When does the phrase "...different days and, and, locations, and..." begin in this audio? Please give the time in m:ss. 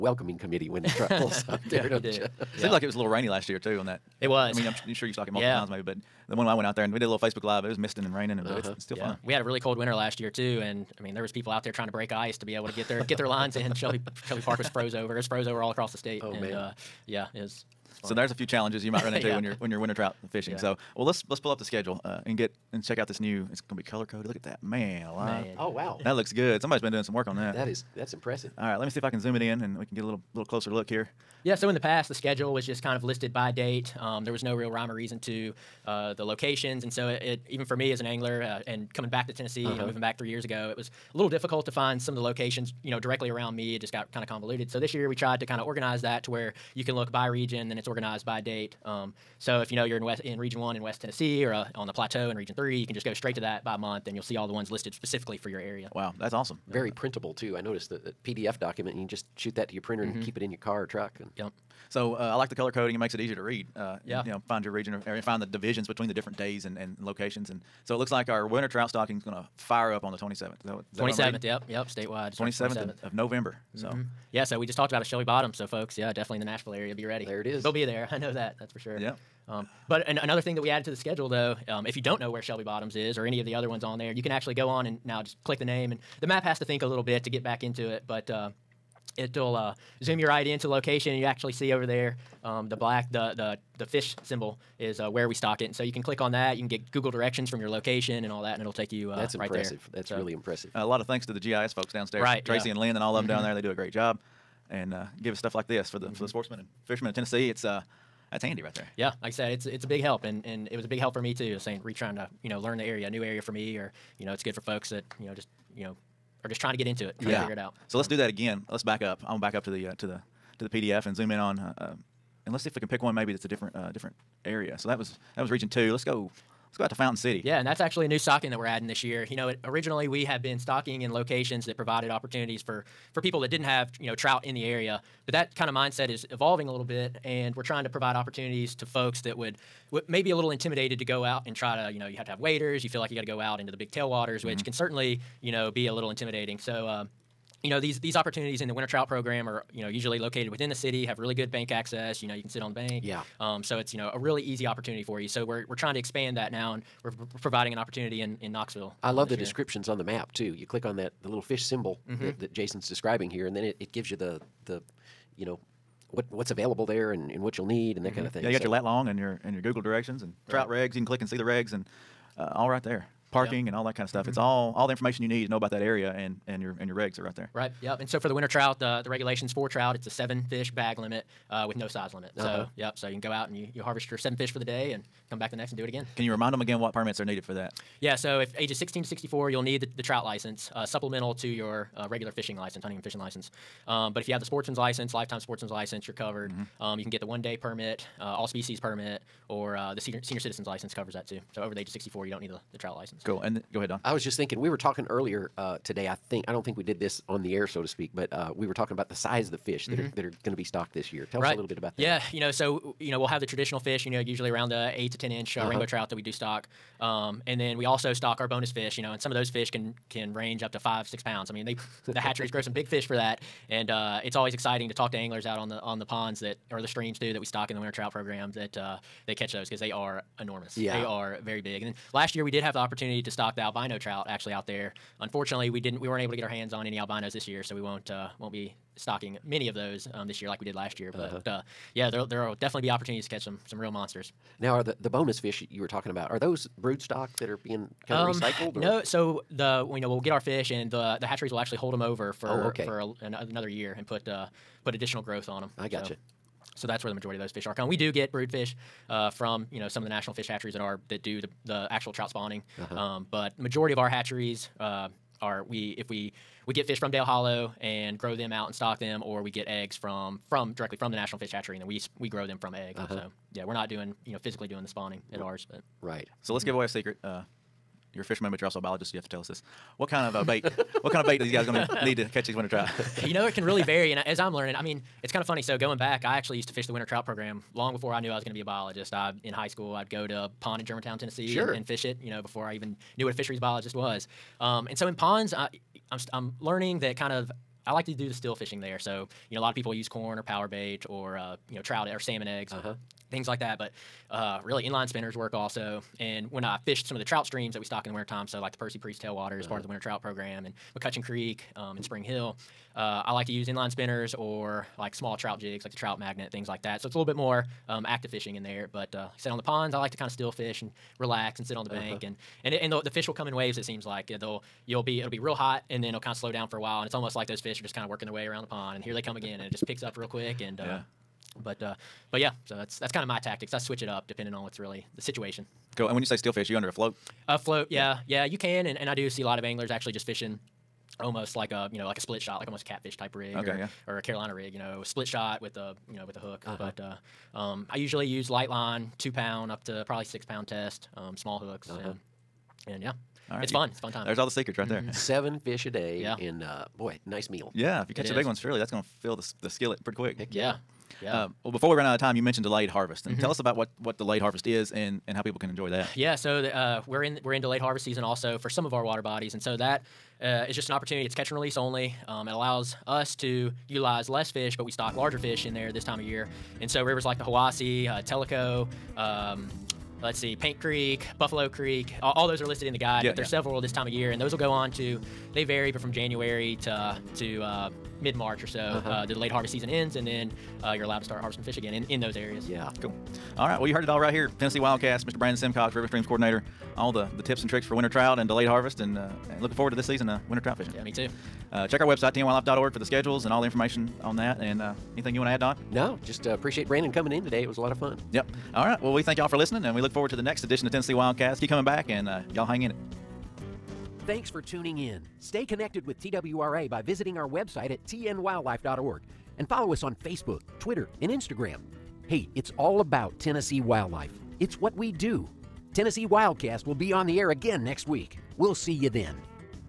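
1:06.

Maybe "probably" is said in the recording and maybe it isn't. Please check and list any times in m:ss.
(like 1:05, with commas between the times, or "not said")
5:50.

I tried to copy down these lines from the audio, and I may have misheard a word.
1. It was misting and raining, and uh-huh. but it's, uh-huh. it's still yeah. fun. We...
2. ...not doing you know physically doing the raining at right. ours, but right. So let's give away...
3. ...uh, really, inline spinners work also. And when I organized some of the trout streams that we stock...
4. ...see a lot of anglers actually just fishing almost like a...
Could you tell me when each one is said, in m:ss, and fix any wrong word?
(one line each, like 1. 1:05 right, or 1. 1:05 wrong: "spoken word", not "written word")
1. 0:07 right
2. 4:33 wrong: "spawning", not "raining"
3. 5:04 wrong: "fished", not "organized"
4. 5:39 right.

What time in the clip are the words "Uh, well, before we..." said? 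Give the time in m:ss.
6:01.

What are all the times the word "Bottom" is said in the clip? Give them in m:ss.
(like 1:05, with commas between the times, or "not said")
1:15, 1:22.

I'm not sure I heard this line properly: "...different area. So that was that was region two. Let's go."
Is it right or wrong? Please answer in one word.
right.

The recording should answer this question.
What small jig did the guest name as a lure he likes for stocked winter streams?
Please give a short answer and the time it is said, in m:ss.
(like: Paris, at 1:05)
trout magnet, at 5:15.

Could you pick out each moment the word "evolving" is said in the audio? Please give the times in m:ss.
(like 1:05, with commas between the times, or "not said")
2:16.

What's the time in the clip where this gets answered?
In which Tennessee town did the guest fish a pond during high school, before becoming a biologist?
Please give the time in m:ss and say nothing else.
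4:50.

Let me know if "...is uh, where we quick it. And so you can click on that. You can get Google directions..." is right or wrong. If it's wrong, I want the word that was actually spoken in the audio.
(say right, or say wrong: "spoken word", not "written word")
wrong: "stock", not "quick".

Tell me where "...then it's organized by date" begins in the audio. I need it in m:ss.
0:47.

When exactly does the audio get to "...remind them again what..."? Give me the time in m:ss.
3:06.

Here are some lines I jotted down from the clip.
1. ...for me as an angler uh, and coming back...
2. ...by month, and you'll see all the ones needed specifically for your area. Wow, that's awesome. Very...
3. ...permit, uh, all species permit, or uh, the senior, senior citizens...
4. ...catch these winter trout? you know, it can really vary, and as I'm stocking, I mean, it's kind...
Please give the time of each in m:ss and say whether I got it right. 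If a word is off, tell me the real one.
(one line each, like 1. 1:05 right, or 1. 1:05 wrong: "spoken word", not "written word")
1. 0:37 right
2. 0:53 wrong: "listed", not "needed"
3. 3:17 right
4. 4:42 wrong: "learning", not "stocking".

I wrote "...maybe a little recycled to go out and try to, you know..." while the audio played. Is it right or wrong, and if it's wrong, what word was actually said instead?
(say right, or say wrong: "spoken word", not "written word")
wrong: "intimidated", not "recycled".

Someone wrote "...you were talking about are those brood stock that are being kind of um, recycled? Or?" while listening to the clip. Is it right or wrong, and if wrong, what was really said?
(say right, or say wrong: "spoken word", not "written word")
right.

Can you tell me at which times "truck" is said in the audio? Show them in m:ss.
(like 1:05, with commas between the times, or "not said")
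0:00, 1:00.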